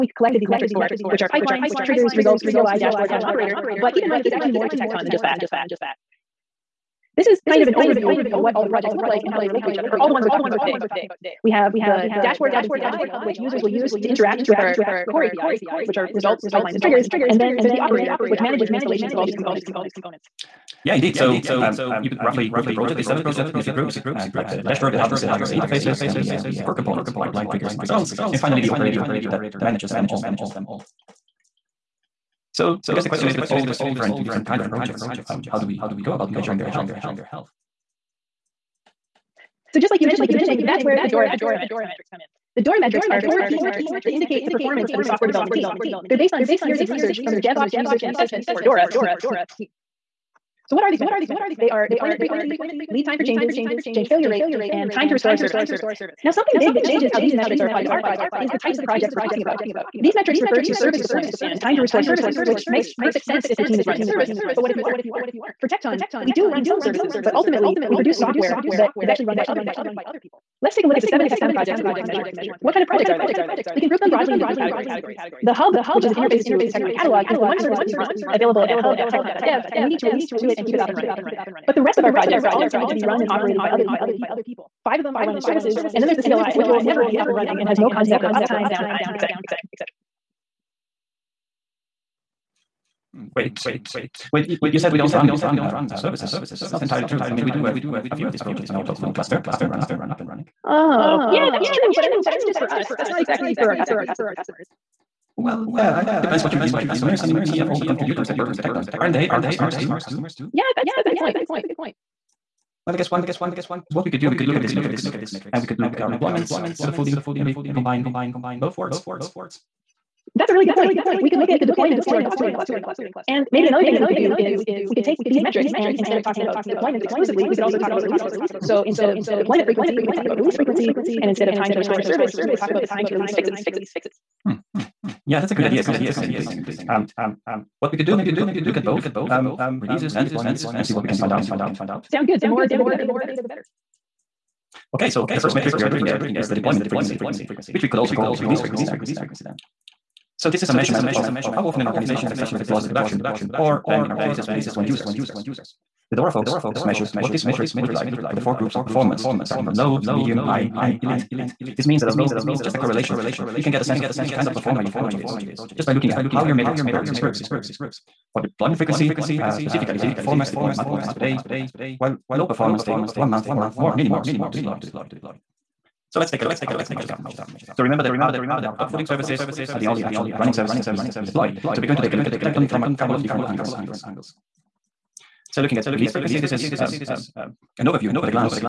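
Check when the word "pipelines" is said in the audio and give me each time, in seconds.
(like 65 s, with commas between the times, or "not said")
1 s, 16 s, 27 s.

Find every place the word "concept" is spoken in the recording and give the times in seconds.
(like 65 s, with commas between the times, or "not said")
87 s.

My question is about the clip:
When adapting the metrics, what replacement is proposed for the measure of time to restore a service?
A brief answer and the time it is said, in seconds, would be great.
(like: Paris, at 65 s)
time to release fixes, at 132 s.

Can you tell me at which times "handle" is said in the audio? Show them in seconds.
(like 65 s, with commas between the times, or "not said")
not said.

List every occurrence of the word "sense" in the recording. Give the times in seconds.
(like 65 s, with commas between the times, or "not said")
63 s, 163 s.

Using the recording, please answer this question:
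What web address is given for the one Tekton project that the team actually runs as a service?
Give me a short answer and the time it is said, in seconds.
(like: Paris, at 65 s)
hub.tekton.dev, at 78 s.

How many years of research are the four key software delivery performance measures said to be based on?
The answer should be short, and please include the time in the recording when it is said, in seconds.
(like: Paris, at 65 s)
6, at 46 s.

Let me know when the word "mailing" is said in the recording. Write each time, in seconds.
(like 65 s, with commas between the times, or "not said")
not said.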